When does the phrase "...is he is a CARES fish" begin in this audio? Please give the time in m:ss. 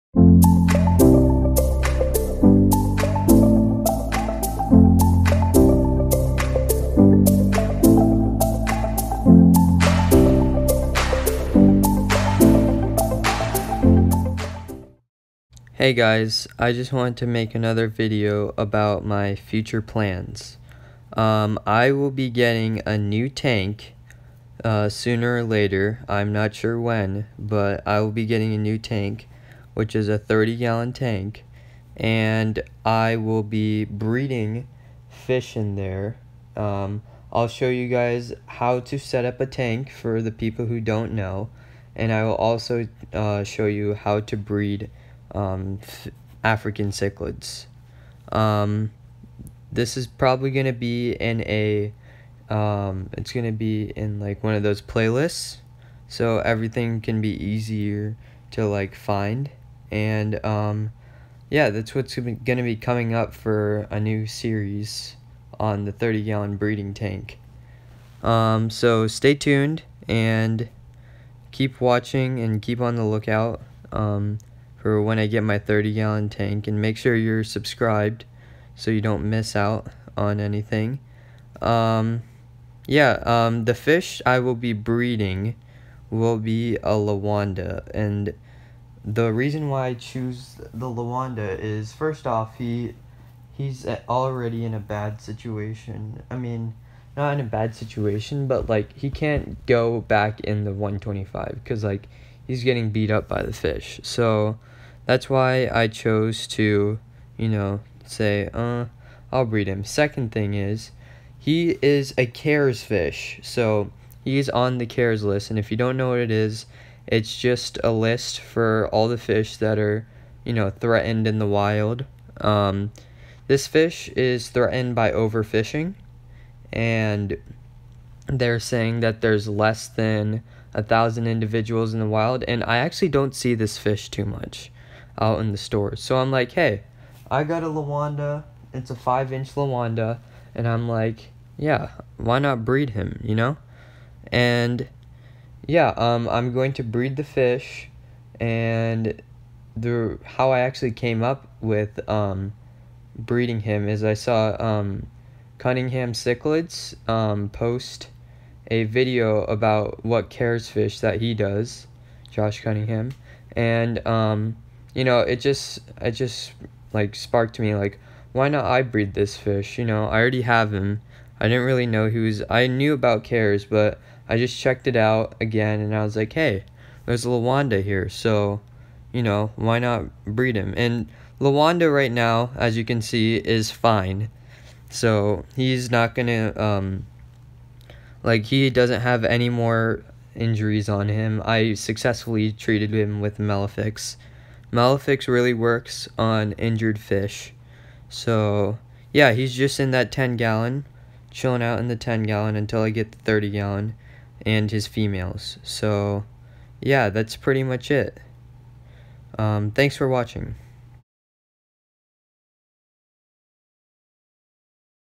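1:50.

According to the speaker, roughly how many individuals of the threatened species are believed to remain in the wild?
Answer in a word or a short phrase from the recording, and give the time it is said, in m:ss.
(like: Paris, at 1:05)
less than 1,000, at 2:09.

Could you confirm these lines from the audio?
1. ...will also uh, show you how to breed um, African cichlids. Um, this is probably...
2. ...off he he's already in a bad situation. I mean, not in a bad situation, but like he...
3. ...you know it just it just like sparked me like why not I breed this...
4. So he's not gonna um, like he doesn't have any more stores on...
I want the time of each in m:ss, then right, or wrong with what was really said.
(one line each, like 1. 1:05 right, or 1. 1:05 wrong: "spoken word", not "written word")
1. 0:42 right
2. 1:32 right
3. 2:44 right
4. 3:04 wrong: "injuries", not "stores".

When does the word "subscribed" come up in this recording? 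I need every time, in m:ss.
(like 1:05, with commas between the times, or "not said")
1:17.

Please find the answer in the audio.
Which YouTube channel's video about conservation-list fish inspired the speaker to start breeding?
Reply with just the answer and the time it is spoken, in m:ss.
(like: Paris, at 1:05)
Cunningham Cichlids, at 2:35.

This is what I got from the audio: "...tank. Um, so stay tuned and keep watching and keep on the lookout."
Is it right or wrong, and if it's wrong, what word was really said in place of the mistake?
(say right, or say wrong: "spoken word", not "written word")
right.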